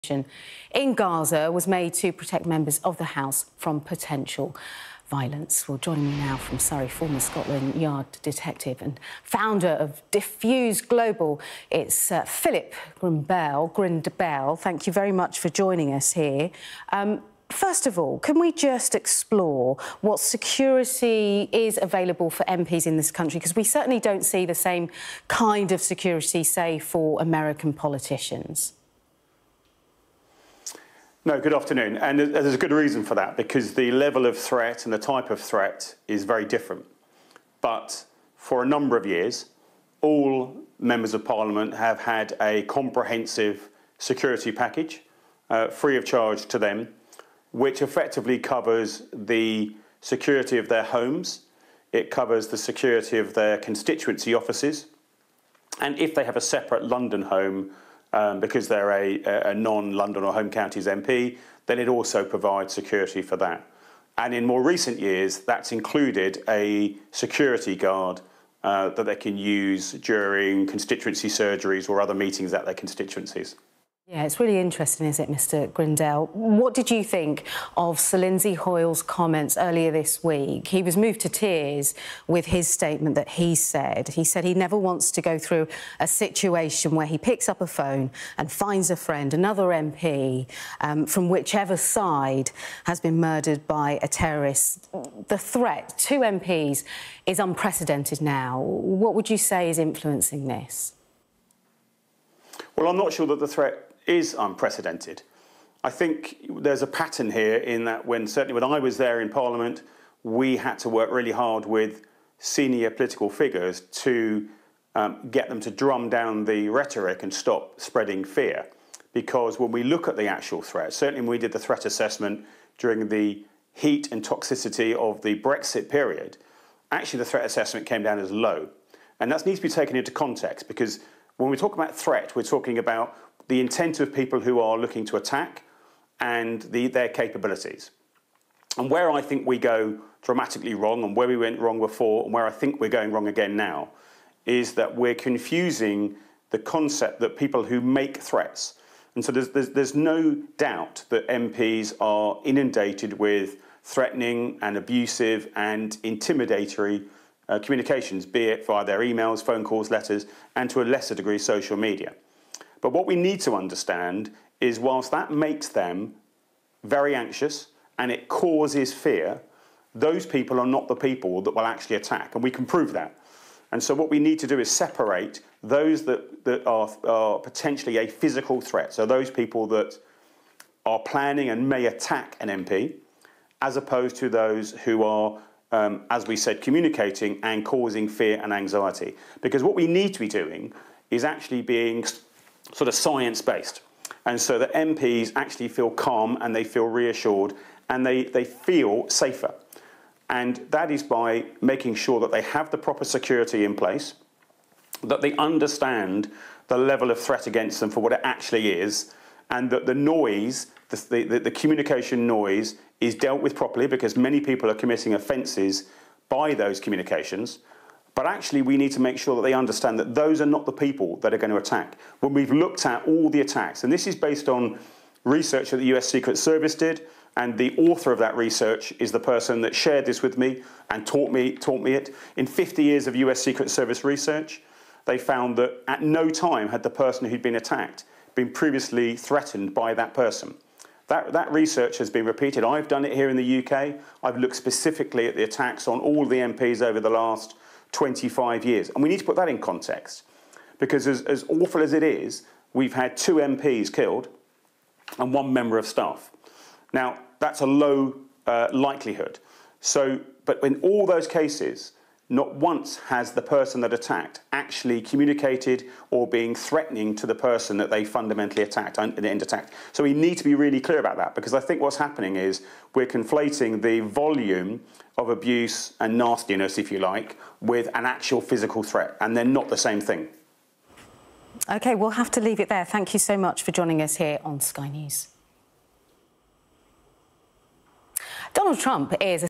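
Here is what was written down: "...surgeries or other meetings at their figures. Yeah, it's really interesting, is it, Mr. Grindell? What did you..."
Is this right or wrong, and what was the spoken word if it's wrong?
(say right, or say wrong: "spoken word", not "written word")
wrong: "constituencies", not "figures".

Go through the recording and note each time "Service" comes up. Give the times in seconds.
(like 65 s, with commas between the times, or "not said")
226 s, 233 s.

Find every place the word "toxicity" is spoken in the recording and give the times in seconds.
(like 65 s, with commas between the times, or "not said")
124 s.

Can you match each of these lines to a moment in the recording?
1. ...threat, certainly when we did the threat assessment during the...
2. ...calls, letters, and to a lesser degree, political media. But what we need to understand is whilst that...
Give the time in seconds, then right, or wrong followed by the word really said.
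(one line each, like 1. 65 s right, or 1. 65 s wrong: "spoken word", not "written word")
1. 120 s right
2. 159 s wrong: "social", not "political".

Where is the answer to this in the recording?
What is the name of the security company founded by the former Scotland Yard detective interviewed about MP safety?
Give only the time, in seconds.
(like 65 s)
10 s.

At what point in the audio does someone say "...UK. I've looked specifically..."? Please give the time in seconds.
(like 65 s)
243 s.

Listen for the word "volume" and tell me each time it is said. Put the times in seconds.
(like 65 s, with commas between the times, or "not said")
273 s.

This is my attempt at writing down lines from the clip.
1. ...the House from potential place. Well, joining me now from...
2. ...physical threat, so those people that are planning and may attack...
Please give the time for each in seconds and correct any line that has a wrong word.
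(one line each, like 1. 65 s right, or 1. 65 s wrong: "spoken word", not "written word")
1. 2 s wrong: "violence", not "place"
2. 178 s right.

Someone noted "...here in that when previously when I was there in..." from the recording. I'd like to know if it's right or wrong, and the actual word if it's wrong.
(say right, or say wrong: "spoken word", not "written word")
wrong: "certainly", not "previously".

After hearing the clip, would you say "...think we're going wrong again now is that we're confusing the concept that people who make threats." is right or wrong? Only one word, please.
right.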